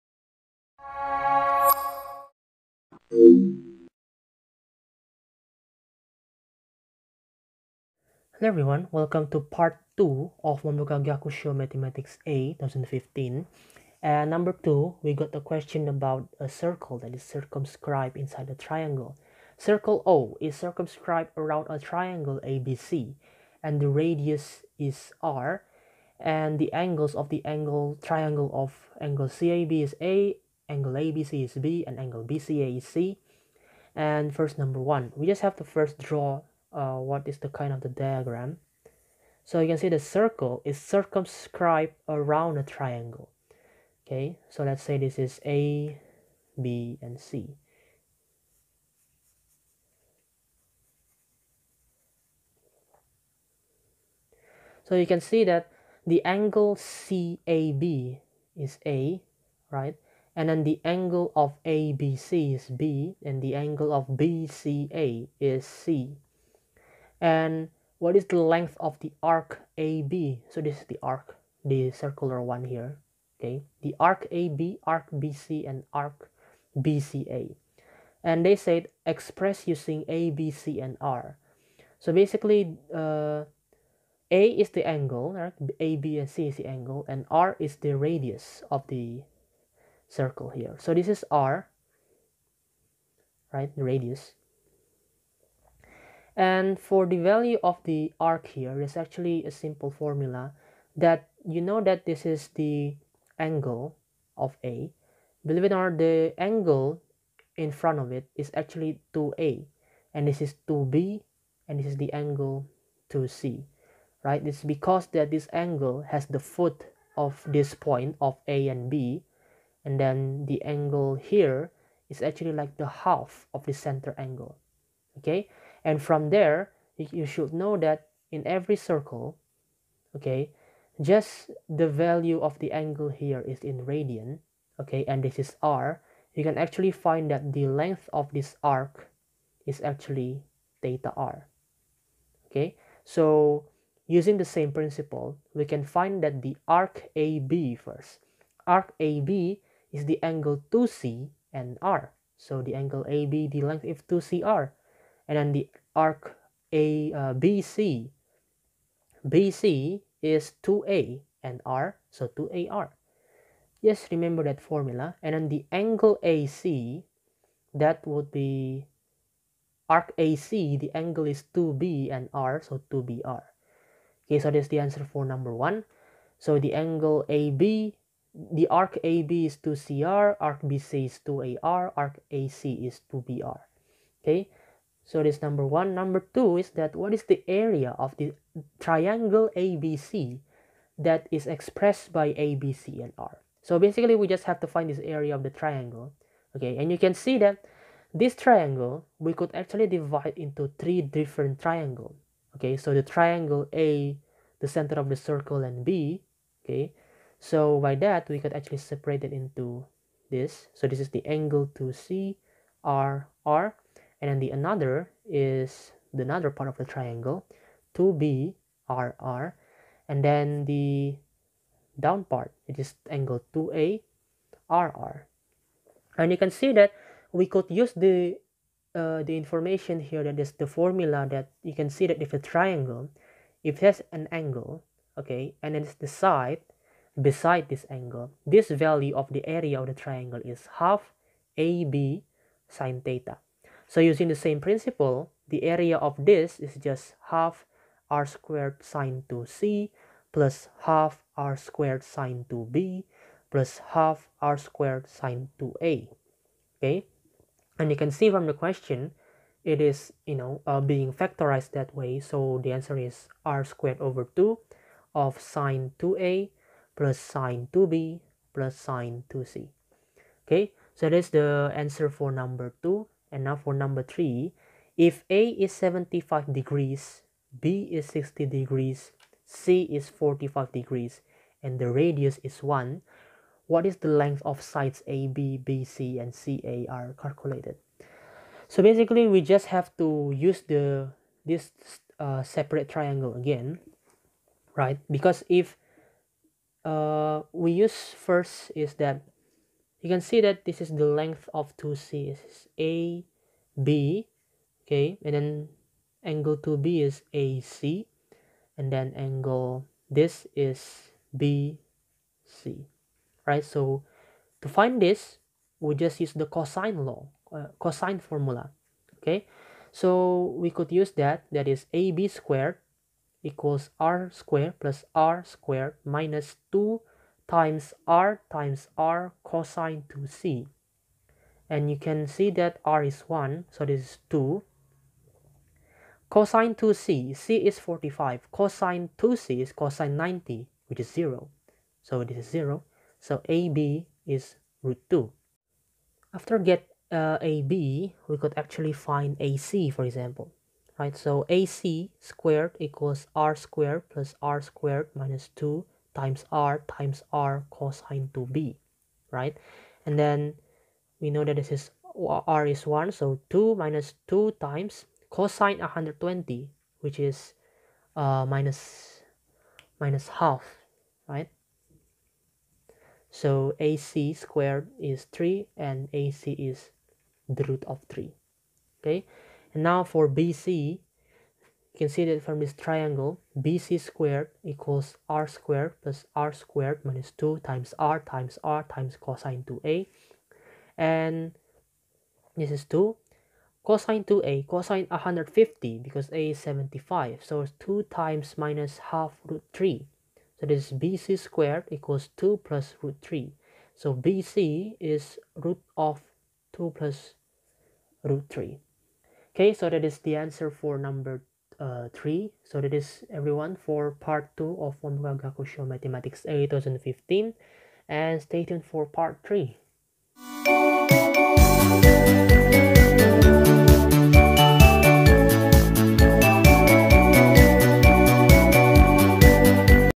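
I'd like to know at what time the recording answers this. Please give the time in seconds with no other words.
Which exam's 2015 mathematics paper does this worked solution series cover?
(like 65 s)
10 s.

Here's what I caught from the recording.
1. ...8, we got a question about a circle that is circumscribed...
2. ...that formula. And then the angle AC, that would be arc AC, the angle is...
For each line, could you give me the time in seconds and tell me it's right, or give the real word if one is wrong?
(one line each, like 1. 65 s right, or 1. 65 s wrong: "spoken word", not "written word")
1. 14 s wrong: "2", not "8"
2. 164 s right.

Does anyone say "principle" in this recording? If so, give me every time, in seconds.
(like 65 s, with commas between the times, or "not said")
144 s, 244 s.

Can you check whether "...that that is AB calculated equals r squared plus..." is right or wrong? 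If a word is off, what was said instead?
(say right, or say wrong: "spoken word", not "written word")
wrong: "squared", not "calculated".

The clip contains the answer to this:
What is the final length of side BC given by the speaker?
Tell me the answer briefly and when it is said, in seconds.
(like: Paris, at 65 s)
root of 2 plus root 3, at 405 s.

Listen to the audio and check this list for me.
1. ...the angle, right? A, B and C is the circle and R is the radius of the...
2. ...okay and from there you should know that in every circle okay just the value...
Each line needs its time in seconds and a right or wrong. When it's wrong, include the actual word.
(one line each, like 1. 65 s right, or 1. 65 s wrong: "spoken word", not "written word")
1. 84 s wrong: "angle", not "circle"
2. 125 s right.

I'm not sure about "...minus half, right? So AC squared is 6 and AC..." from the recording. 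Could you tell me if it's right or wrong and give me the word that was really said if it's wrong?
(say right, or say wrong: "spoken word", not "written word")
wrong: "3", not "6".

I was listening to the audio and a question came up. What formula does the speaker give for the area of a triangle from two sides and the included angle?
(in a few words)
half AB sine theta.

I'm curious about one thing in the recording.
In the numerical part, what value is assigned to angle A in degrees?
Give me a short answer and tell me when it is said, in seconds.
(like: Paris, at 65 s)
75, at 275 s.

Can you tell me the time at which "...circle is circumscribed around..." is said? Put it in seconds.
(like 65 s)
39 s.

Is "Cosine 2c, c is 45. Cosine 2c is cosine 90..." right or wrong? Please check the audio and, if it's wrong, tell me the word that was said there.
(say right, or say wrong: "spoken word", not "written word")
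right.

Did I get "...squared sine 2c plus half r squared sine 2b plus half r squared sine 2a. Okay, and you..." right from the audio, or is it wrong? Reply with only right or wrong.
right.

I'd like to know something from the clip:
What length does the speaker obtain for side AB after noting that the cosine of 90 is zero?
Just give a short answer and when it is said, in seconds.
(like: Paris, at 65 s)
root 2, at 344 s.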